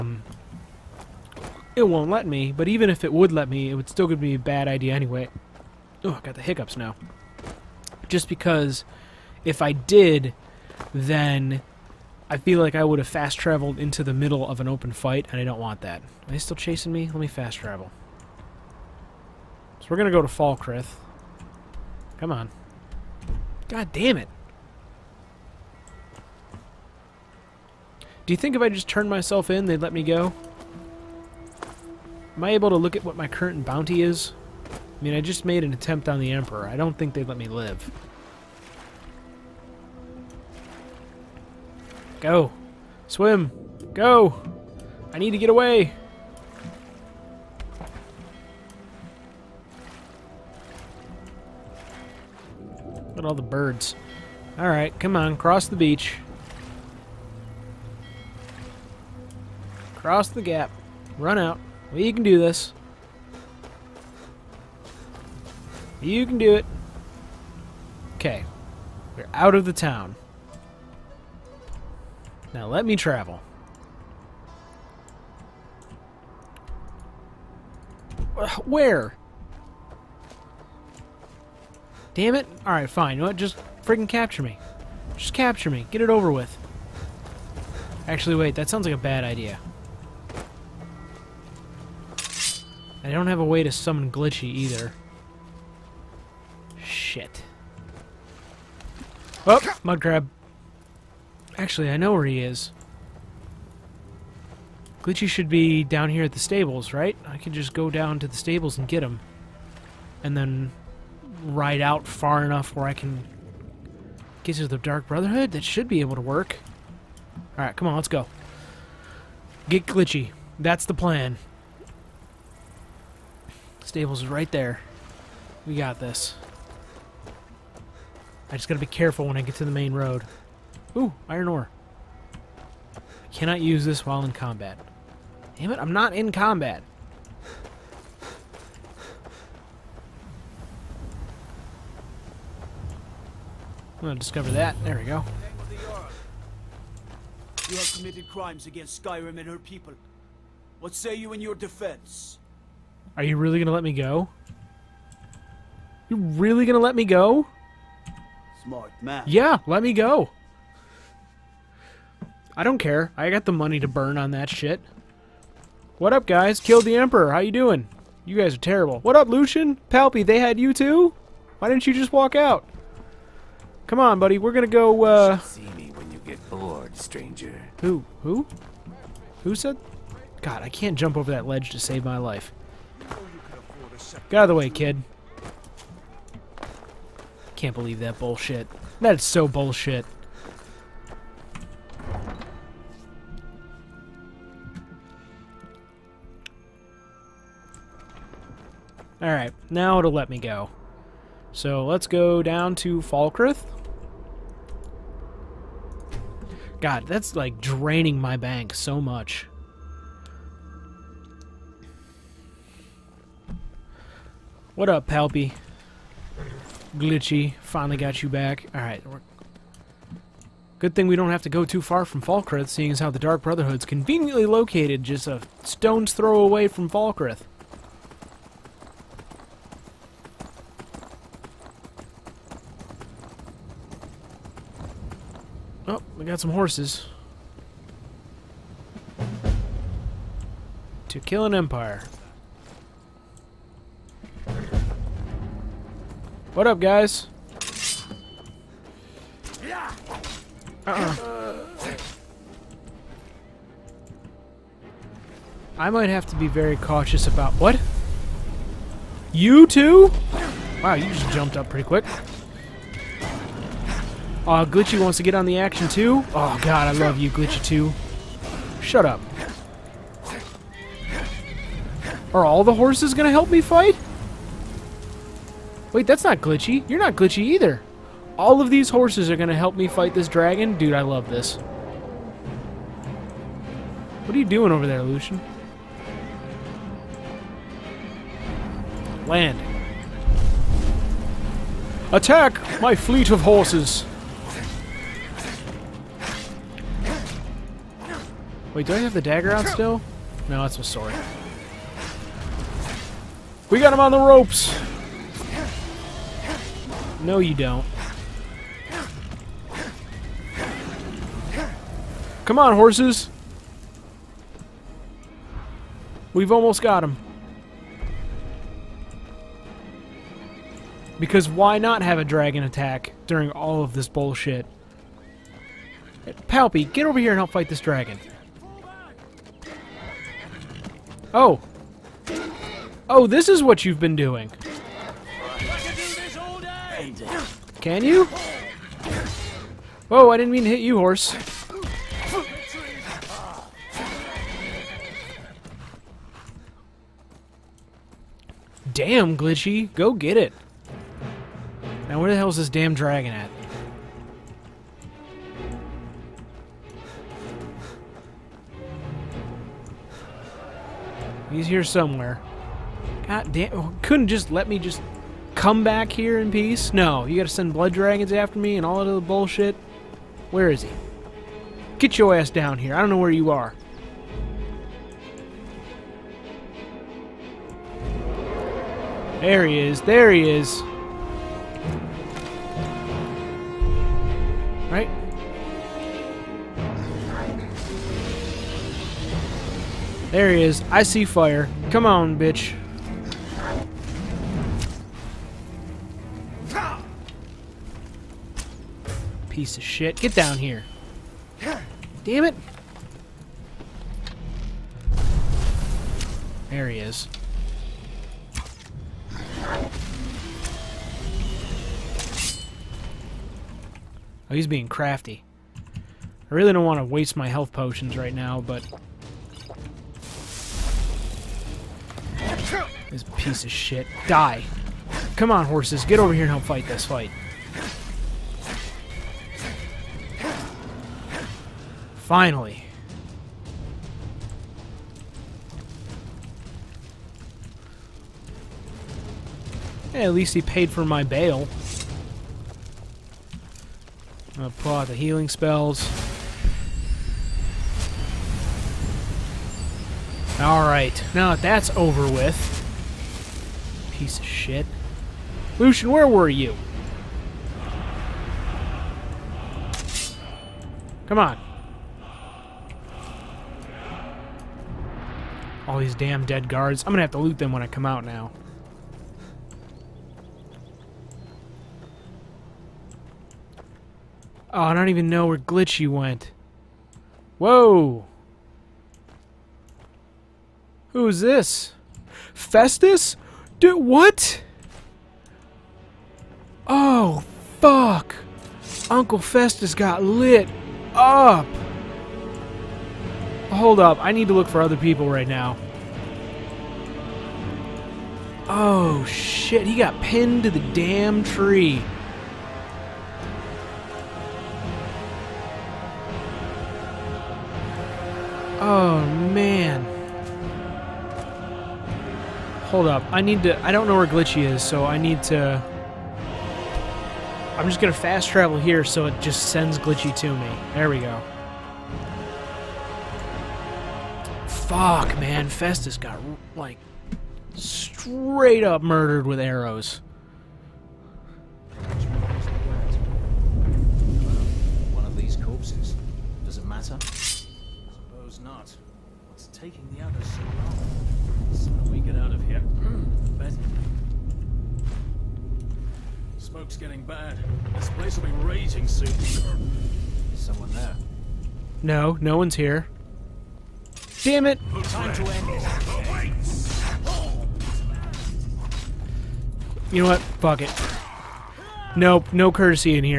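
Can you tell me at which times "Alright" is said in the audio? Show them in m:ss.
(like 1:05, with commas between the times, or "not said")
0:54, 1:22, 1:57, 3:19, 3:38, 7:30.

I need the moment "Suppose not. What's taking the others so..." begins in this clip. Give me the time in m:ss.
8:57.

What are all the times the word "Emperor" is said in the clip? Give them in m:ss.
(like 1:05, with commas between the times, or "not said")
0:36, 2:46.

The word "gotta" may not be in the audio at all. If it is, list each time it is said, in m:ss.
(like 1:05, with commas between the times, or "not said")
2:08, 6:07.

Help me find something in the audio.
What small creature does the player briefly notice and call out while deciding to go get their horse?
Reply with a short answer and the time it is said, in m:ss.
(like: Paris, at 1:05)
mud crab, at 1:39.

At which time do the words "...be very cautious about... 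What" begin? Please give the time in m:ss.
4:16.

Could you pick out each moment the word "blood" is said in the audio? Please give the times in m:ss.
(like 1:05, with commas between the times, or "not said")
6:07.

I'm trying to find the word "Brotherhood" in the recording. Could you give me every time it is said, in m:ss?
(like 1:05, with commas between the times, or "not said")
1:55, 3:43.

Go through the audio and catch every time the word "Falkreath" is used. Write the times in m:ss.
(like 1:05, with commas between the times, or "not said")
0:20, 3:23, 3:42, 3:46.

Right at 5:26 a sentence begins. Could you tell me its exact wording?
Palpy, get over here and help fight this dragon.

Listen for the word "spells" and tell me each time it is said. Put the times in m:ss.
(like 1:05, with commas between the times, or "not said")
7:25.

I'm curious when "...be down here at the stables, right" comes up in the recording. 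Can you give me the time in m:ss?
1:45.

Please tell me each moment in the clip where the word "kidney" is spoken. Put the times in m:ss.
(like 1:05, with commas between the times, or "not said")
not said.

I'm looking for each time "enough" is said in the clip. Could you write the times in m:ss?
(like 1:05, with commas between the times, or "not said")
1:52.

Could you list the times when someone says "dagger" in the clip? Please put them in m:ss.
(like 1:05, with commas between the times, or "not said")
4:59.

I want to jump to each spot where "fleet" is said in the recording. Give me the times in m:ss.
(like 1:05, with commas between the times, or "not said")
4:52.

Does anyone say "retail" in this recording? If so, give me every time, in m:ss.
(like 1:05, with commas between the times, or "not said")
not said.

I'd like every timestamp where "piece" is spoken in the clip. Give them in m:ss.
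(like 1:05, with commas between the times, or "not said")
6:39, 7:03, 7:34.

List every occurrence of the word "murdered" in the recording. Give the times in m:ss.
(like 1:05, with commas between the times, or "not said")
8:49.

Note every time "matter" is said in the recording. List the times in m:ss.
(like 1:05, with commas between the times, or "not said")
8:56.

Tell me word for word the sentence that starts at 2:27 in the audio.
You have committed crimes against Skyrim and her people.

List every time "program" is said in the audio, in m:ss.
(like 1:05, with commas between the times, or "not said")
not said.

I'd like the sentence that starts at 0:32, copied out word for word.
Am I able to look at what my current bounty is?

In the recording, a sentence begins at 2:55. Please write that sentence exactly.
See me when you get bored, stranger.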